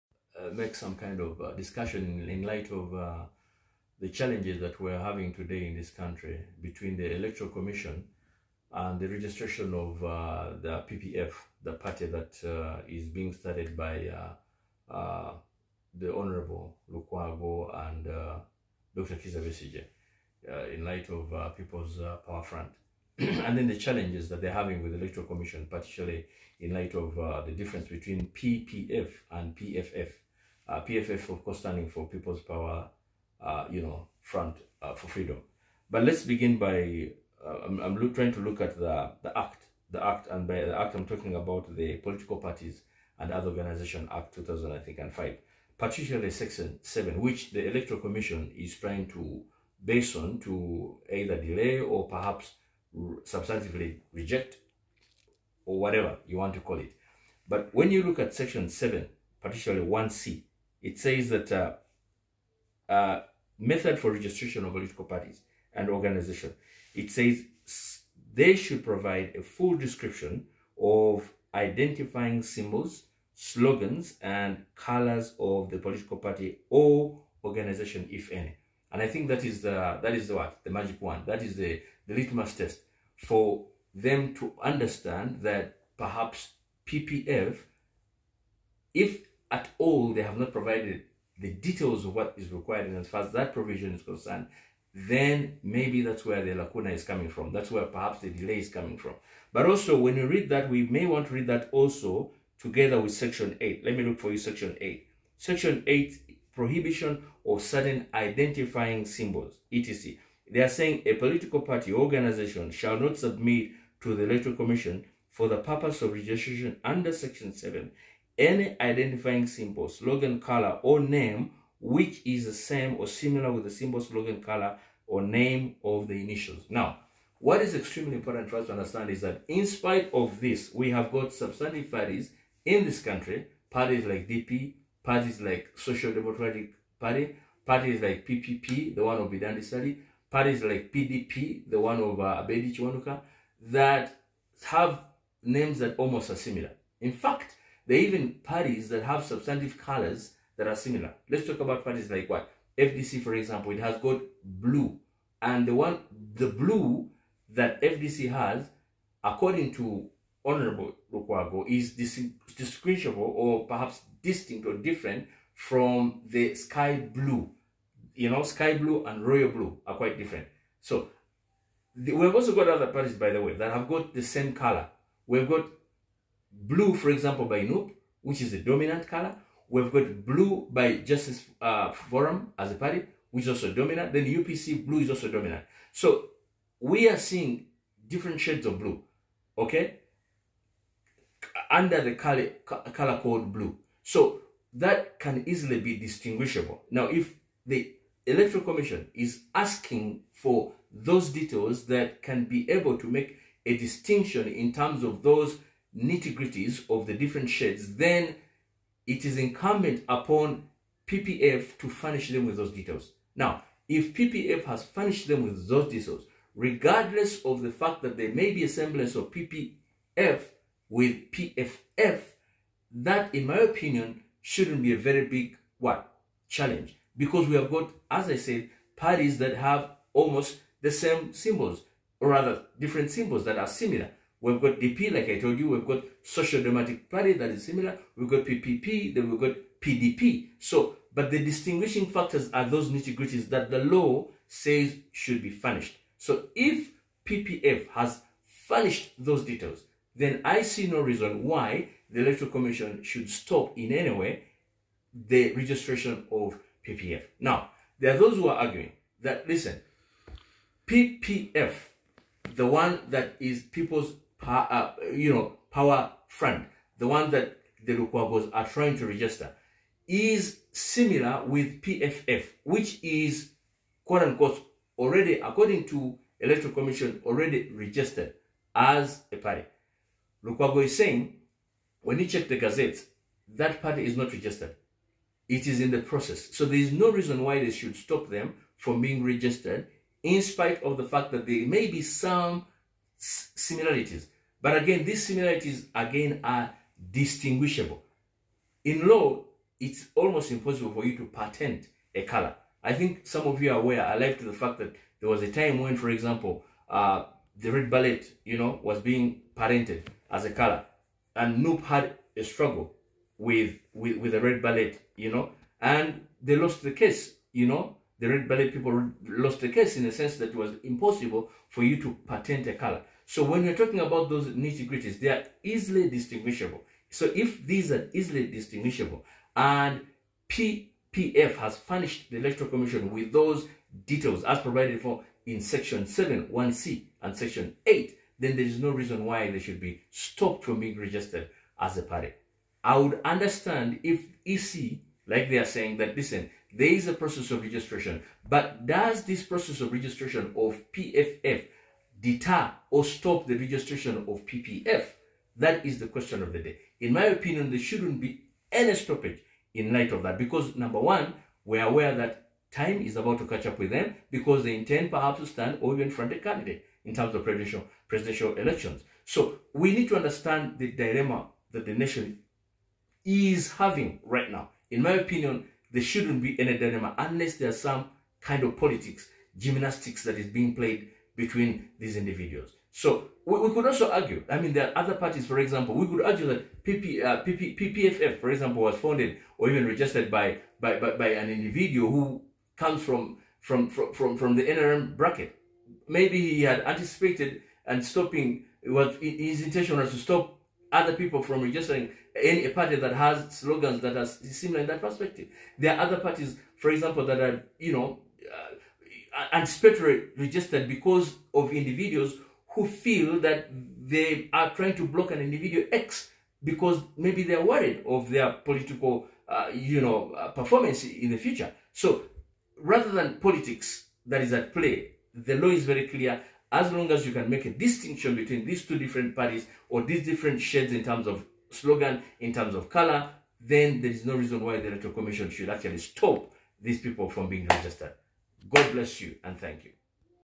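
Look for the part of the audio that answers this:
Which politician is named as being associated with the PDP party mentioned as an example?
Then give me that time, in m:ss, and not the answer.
2:22.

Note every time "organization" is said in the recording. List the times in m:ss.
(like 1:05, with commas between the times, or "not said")
0:43, 1:05, 1:17, 1:51.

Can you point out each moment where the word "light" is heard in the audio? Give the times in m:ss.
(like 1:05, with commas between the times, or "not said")
0:02, 0:20, 0:26, 5:59.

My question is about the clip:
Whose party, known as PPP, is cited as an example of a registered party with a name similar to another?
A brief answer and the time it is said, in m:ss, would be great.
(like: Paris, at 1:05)
Bidandi Sali, at 2:19.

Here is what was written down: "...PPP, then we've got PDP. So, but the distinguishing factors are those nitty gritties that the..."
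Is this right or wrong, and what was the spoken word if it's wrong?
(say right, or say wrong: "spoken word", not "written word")
right.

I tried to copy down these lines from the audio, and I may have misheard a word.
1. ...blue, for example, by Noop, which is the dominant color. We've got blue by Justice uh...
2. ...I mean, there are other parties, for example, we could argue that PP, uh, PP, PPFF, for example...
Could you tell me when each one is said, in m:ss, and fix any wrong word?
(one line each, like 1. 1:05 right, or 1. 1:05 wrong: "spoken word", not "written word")
1. 2:56 right
2. 6:24 right.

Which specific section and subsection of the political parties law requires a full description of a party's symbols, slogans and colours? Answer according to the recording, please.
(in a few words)
Section 7(1)(c).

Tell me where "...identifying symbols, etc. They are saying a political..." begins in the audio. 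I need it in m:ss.
1:48.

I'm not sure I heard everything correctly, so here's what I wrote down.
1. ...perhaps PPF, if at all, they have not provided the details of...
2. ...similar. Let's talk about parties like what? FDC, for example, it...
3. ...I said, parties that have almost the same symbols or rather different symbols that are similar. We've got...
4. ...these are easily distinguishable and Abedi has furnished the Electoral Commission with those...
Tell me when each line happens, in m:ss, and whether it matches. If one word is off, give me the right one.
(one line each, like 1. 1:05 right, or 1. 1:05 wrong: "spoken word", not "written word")
1. 1:25 right
2. 2:30 right
3. 3:48 right
4. 5:27 wrong: "PPF", not "Abedi".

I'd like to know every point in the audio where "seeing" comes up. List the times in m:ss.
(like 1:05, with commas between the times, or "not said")
3:07.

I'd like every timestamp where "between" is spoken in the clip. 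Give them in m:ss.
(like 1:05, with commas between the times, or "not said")
0:06, 0:27, 6:21, 7:08.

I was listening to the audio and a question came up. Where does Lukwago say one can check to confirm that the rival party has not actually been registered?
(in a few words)
The Gazette.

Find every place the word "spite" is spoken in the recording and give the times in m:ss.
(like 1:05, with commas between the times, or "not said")
2:09, 4:50.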